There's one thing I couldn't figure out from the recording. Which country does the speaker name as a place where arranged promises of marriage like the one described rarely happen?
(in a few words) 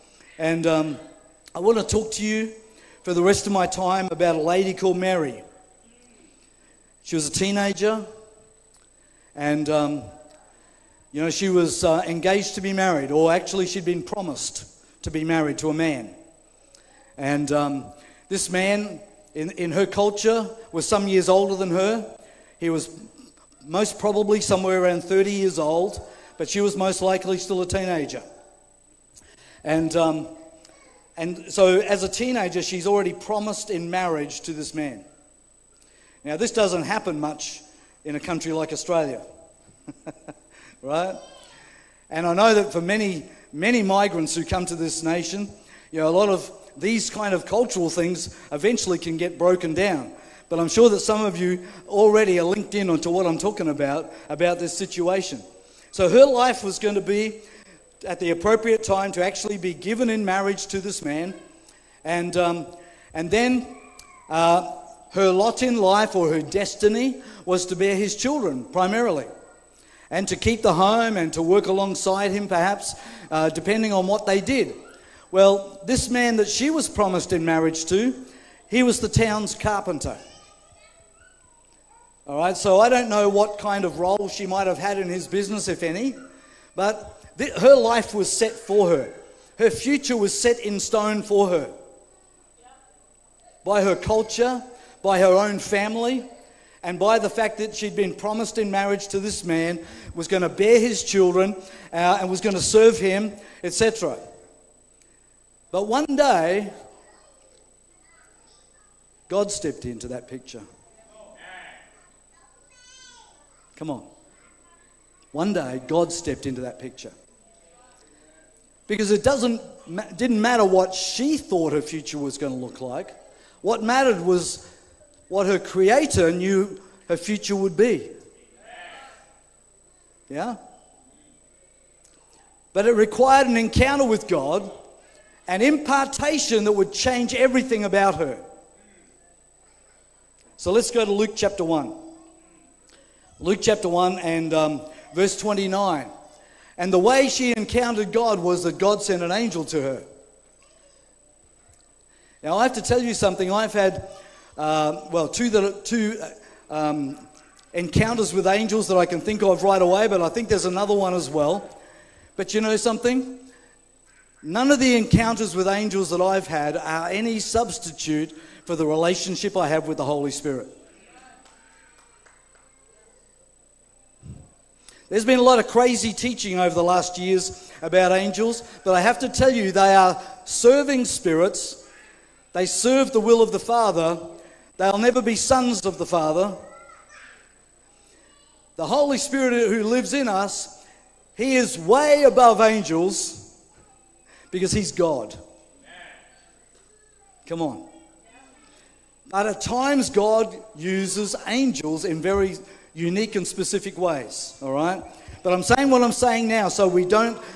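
Australia.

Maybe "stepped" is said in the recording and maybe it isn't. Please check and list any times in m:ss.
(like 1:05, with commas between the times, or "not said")
1:49, 1:56.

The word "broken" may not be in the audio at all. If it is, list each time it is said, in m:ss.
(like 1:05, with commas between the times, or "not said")
0:49.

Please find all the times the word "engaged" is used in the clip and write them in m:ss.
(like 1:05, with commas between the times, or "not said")
0:12.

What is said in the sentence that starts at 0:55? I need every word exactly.
So her life was going to be at the appropriate time to actually be given in marriage to this man.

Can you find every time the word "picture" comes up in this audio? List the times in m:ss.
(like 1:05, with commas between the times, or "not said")
1:50, 1:56.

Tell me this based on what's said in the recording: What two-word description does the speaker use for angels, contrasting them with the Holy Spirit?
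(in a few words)
Serving spirits.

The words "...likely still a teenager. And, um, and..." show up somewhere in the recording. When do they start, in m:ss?
0:26.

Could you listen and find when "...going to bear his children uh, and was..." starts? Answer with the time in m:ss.
1:40.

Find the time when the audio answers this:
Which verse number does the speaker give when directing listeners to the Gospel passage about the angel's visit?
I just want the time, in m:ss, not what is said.
2:25.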